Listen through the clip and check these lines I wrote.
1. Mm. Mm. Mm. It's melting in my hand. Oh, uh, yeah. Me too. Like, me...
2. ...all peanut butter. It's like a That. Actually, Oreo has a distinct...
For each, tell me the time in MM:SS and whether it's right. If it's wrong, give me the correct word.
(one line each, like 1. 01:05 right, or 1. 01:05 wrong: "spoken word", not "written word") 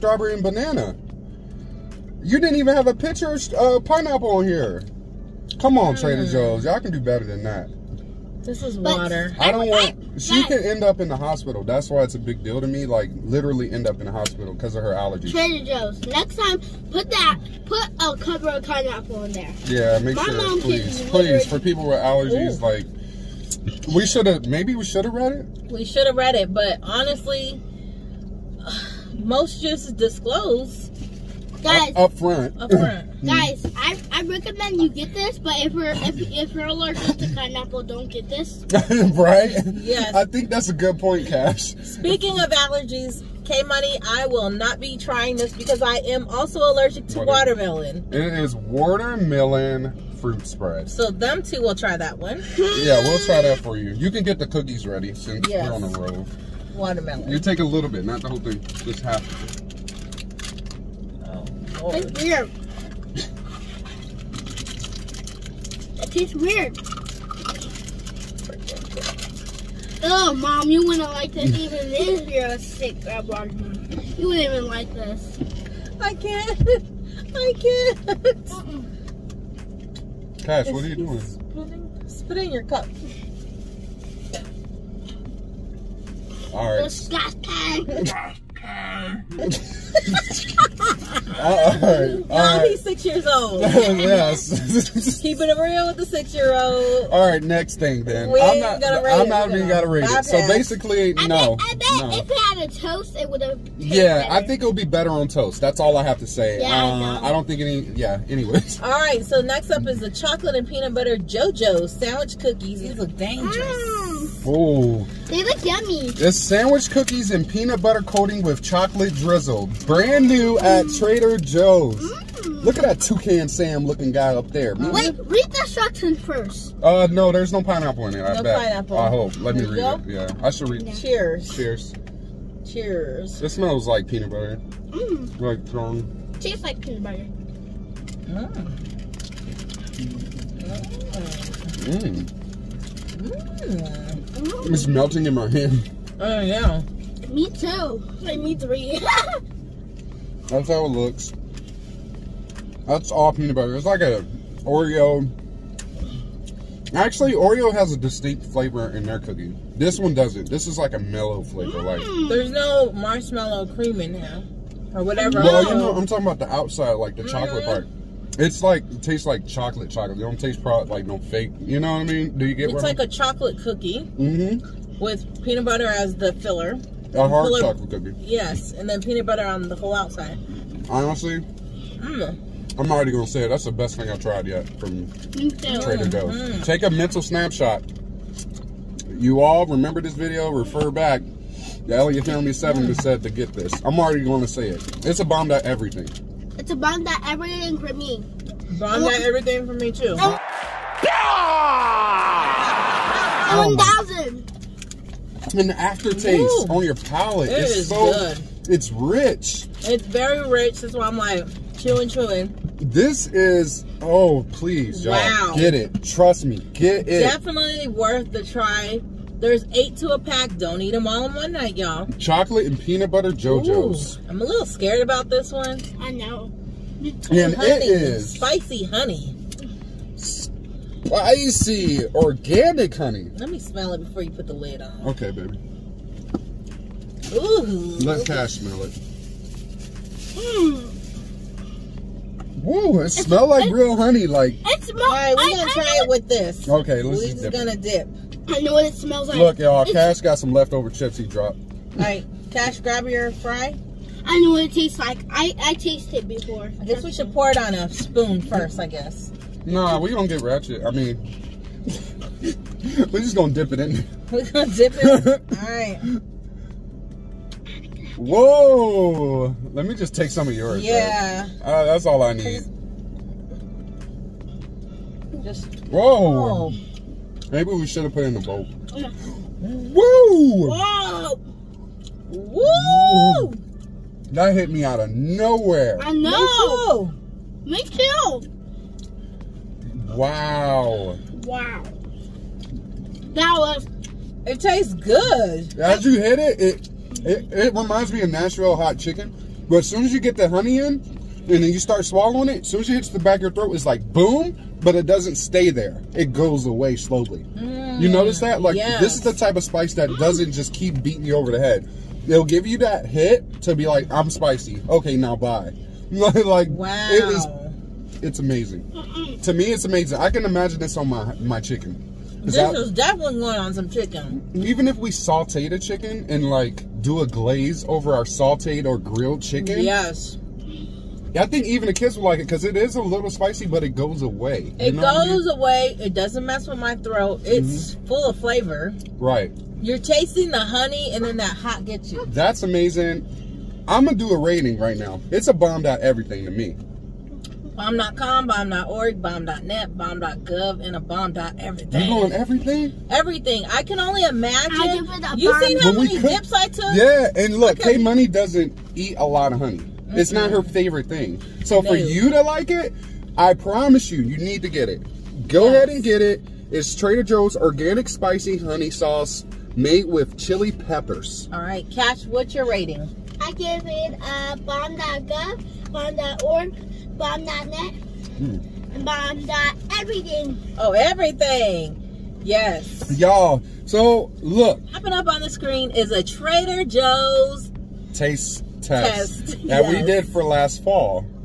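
1. 02:19 right
2. 02:33 wrong: "Oreo", not "That".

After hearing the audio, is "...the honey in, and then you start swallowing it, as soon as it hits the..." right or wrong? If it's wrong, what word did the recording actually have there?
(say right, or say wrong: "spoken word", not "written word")
right.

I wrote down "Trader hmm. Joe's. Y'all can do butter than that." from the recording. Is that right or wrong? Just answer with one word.
wrong.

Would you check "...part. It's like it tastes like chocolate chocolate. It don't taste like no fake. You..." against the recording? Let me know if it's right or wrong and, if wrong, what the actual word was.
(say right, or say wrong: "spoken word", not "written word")
right.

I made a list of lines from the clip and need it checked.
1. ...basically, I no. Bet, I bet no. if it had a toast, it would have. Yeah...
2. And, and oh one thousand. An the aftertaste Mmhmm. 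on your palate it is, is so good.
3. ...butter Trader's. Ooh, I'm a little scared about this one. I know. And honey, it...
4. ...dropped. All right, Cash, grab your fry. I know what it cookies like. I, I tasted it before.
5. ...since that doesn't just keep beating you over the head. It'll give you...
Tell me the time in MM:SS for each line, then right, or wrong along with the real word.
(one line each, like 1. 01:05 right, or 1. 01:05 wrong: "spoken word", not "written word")
1. 01:40 right
2. 03:20 wrong: "Ooh", not "Mmhmm"
3. 03:43 wrong: "JoJo", not "Trader"
4. 04:11 wrong: "tastes", not "cookies"
5. 05:09 wrong: "spice", not "since".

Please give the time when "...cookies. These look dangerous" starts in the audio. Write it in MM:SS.
01:52.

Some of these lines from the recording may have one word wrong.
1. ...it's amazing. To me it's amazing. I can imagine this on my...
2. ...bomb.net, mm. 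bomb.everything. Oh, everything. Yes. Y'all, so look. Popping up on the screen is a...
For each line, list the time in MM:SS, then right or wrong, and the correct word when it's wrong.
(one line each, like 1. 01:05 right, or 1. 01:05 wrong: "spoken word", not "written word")
1. 05:18 right
2. 06:17 right.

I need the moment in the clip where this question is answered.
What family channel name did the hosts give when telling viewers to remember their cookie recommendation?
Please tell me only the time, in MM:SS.
03:11.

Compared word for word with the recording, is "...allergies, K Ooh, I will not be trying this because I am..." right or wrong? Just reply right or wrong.
wrong.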